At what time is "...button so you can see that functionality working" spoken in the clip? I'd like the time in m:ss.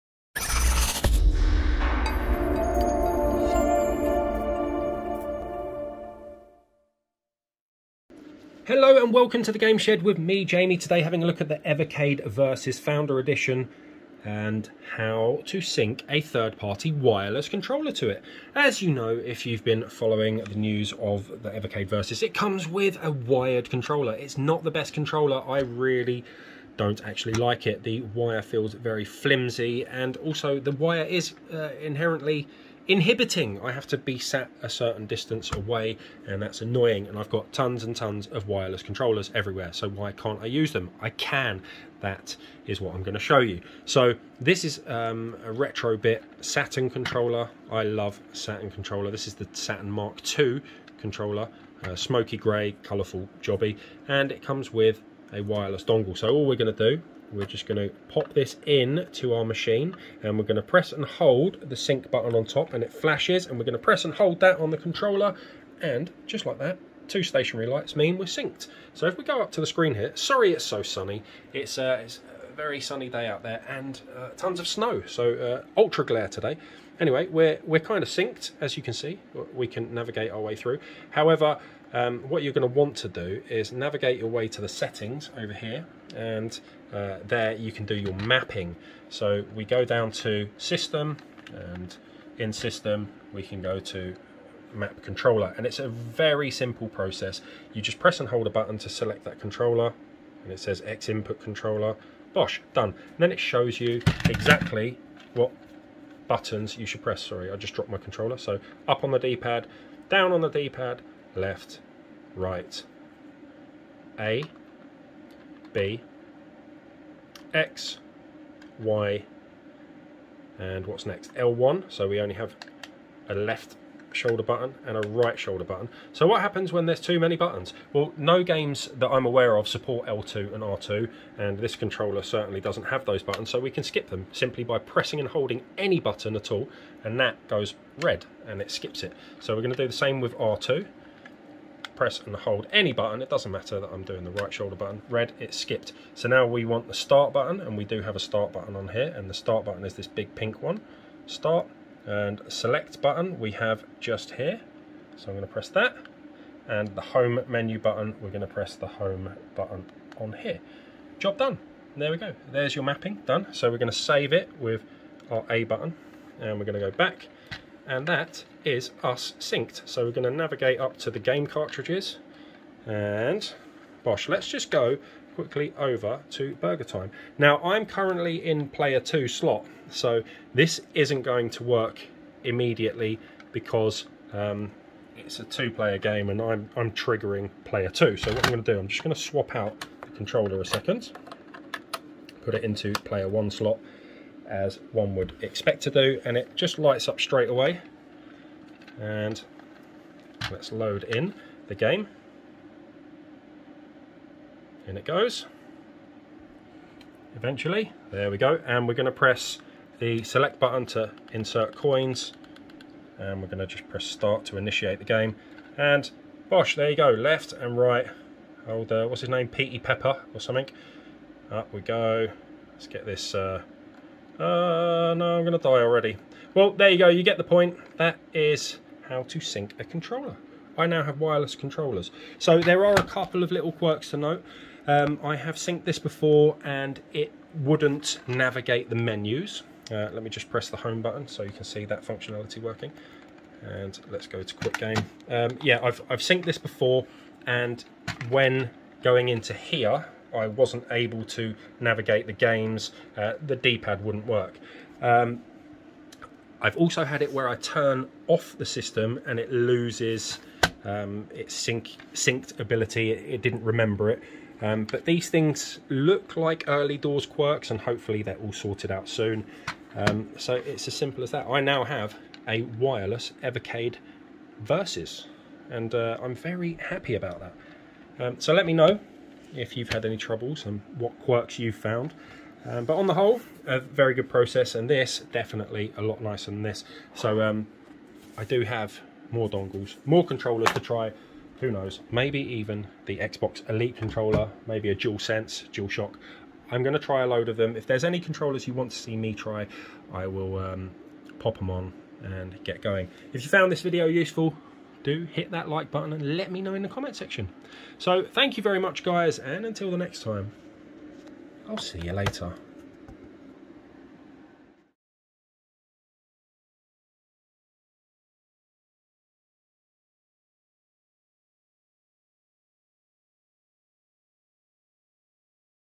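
4:01.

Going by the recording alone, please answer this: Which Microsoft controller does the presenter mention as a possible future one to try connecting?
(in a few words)
Xbox Elite controller.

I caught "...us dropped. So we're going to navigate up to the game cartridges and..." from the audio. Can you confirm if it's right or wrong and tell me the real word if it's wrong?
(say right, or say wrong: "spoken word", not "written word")
wrong: "synced", not "dropped".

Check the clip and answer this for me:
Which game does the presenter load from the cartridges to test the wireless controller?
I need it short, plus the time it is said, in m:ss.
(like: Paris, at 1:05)
BurgerTime, at 2:56.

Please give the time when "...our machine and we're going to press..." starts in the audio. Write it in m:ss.
0:59.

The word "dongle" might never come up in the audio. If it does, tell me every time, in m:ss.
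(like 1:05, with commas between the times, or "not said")
0:55, 4:49.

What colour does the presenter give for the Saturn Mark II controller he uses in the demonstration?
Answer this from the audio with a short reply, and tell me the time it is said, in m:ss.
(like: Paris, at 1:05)
Smoky grey, at 0:51.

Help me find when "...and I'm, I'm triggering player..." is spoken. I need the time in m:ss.
3:06.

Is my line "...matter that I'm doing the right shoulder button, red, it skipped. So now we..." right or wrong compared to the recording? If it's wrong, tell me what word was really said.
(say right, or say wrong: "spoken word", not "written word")
right.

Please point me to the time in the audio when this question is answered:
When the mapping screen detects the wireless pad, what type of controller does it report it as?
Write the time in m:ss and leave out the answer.
1:40.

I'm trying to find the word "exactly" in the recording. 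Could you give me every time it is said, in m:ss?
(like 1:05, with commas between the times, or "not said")
1:44.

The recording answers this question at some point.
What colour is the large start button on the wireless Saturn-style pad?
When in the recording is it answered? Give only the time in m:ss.
2:30.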